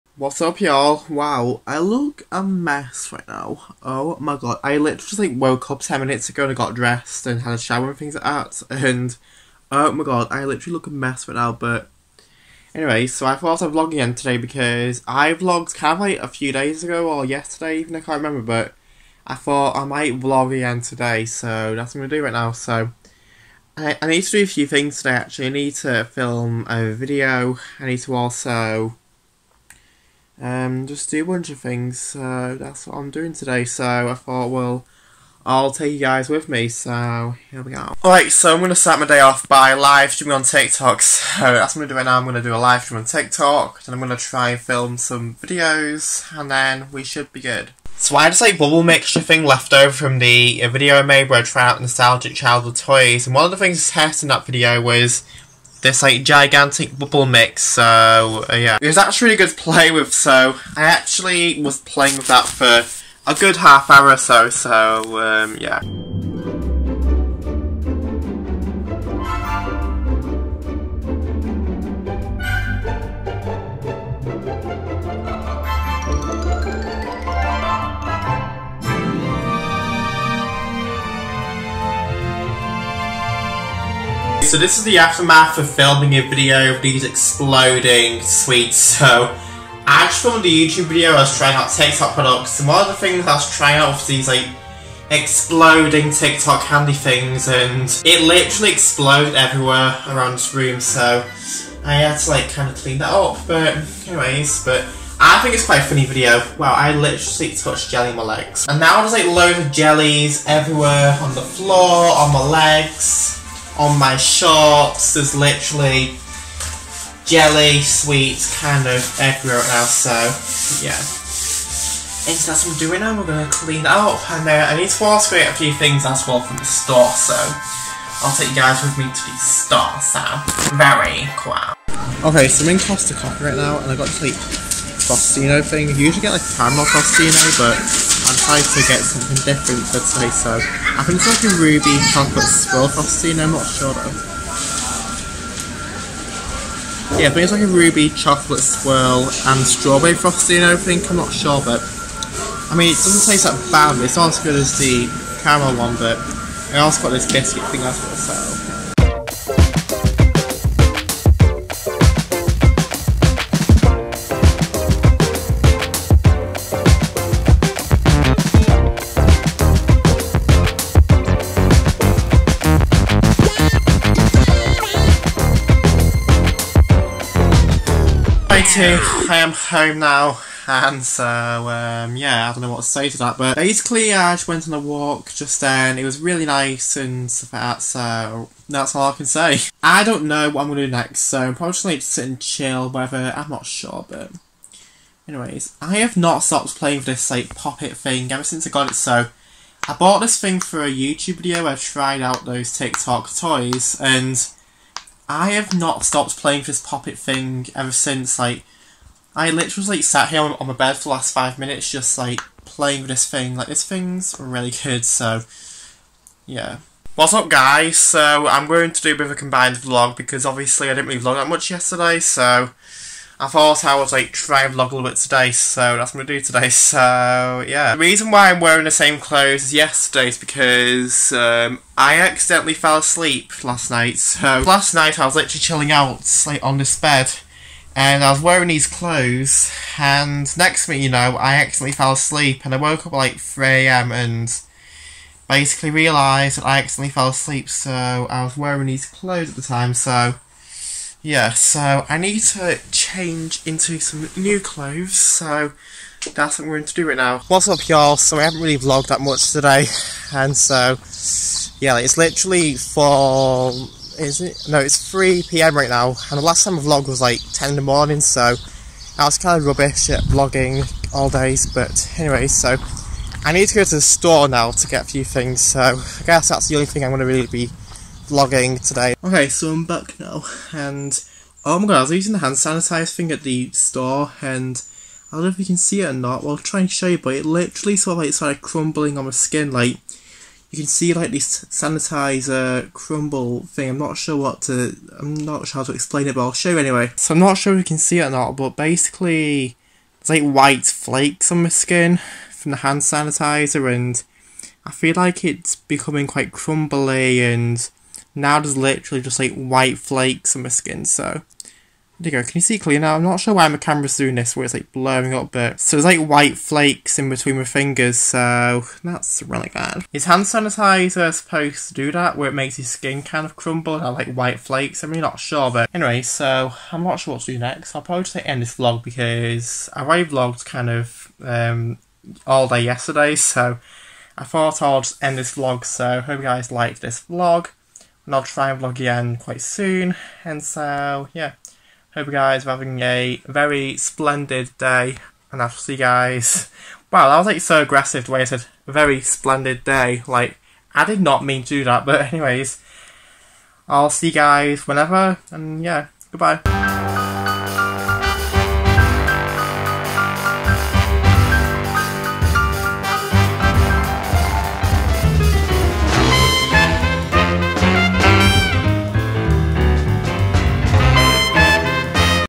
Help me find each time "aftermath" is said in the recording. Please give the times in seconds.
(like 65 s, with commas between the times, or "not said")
84 s.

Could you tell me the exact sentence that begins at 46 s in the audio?
And then we should be good.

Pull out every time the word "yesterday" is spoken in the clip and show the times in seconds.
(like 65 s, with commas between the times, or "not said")
17 s, 221 s, 229 s, 332 s.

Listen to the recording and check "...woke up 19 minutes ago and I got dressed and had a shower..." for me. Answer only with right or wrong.
wrong.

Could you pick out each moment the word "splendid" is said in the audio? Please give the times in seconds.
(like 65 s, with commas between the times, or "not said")
343 s, 349 s.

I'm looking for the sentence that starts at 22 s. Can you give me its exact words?
So I, I need to do a few things today actually.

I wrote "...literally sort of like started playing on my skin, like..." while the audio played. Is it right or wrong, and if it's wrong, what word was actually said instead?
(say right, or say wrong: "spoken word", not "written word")
wrong: "crumbling", not "playing".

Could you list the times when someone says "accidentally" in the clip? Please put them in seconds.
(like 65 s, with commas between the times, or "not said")
232 s, 241 s, 246 s.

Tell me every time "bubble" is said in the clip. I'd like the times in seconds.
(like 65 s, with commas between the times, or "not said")
48 s, 56 s.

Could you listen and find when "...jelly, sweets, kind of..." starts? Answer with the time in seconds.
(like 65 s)
117 s.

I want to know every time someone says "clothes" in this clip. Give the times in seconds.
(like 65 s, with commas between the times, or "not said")
229 s, 238 s, 249 s, 254 s.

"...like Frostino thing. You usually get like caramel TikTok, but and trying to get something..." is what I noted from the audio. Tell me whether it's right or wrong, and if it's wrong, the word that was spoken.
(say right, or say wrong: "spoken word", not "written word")
wrong: "Frostino", not "TikTok".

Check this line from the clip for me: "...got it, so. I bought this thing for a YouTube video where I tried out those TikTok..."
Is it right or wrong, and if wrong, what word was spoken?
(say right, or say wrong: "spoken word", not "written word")
right.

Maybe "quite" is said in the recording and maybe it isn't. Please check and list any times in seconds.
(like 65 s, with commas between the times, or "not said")
105 s, 306 s, 339 s.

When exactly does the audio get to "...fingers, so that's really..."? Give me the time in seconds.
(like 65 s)
317 s.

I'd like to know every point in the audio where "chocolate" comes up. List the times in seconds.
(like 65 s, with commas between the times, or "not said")
142 s, 148 s.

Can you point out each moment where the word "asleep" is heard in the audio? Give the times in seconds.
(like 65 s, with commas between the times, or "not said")
232 s, 242 s, 247 s.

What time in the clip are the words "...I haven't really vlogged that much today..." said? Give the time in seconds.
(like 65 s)
258 s.